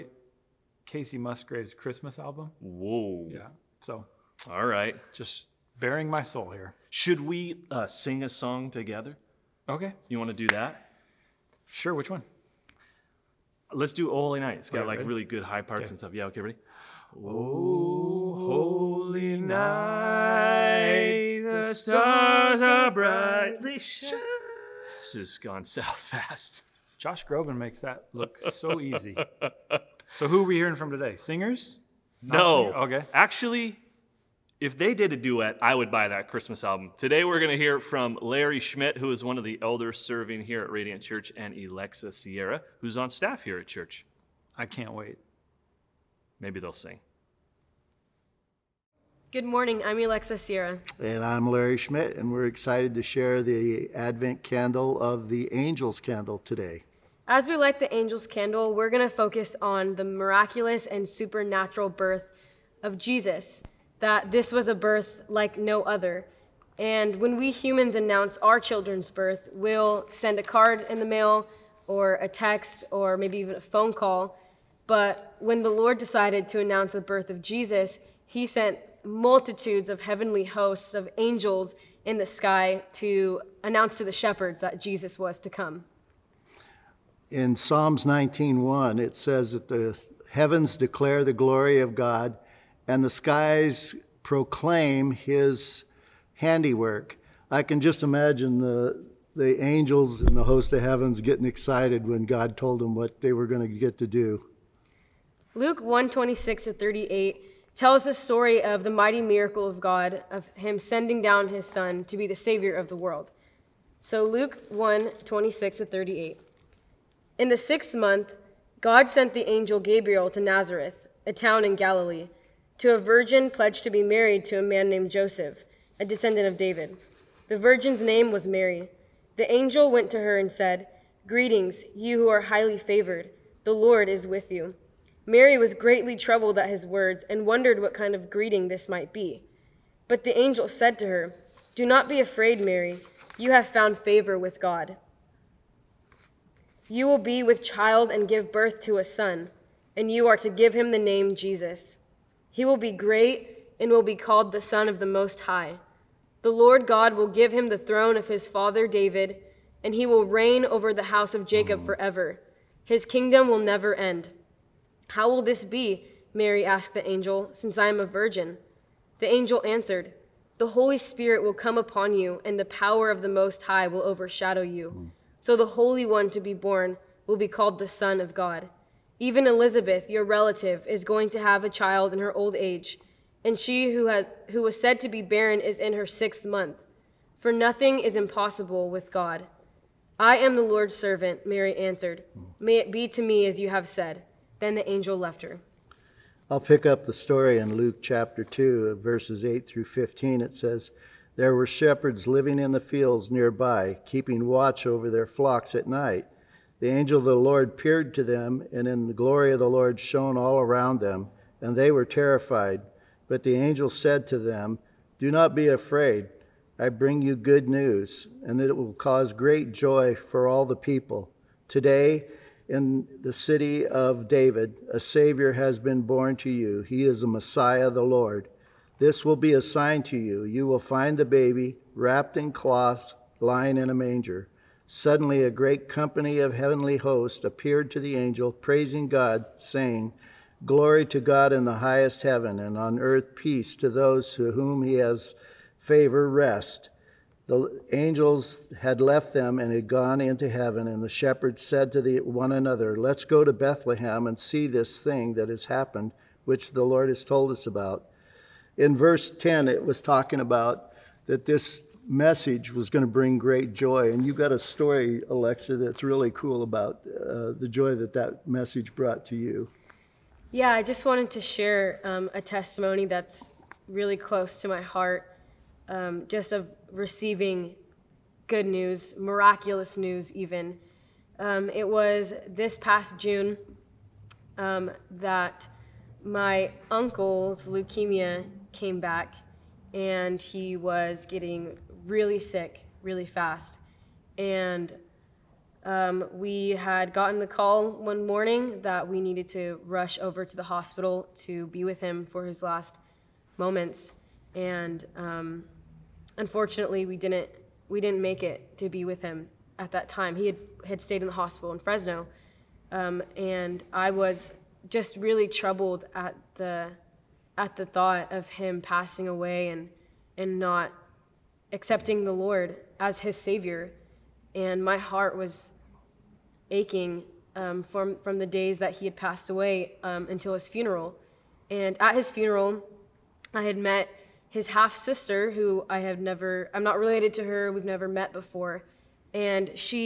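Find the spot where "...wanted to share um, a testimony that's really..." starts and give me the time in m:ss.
4:31.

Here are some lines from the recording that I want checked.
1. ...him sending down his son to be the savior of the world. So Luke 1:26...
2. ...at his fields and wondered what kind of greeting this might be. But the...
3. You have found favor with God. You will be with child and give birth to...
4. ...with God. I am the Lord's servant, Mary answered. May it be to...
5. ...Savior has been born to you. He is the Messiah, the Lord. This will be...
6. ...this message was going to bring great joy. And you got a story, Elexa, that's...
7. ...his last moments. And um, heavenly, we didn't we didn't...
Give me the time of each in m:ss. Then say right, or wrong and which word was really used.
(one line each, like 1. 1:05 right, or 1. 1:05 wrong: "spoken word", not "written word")
1. 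1:50 right
2. 2:16 wrong: "words", not "fields"
3. 2:23 right
4. 3:08 right
5. 3:44 right
6. 4:21 right
7. 5:02 wrong: "unfortunately", not "heavenly".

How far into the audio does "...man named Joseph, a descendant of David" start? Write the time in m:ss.
2:04.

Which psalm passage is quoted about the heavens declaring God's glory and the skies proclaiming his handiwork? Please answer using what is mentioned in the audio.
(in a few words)
Psalms 19:1.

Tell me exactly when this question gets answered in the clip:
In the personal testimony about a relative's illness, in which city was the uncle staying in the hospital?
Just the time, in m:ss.
5:11.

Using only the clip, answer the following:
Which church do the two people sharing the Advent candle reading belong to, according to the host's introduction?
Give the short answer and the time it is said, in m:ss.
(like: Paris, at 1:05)
Radiant Church, at 0:40.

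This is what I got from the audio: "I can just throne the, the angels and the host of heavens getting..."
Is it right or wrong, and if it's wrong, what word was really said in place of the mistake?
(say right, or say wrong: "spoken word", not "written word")
wrong: "imagine", not "throne".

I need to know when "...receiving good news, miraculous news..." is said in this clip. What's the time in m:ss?
4:36.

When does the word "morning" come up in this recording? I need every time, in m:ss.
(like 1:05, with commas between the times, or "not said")
0:49, 4:58.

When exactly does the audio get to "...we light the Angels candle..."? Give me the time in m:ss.
0:57.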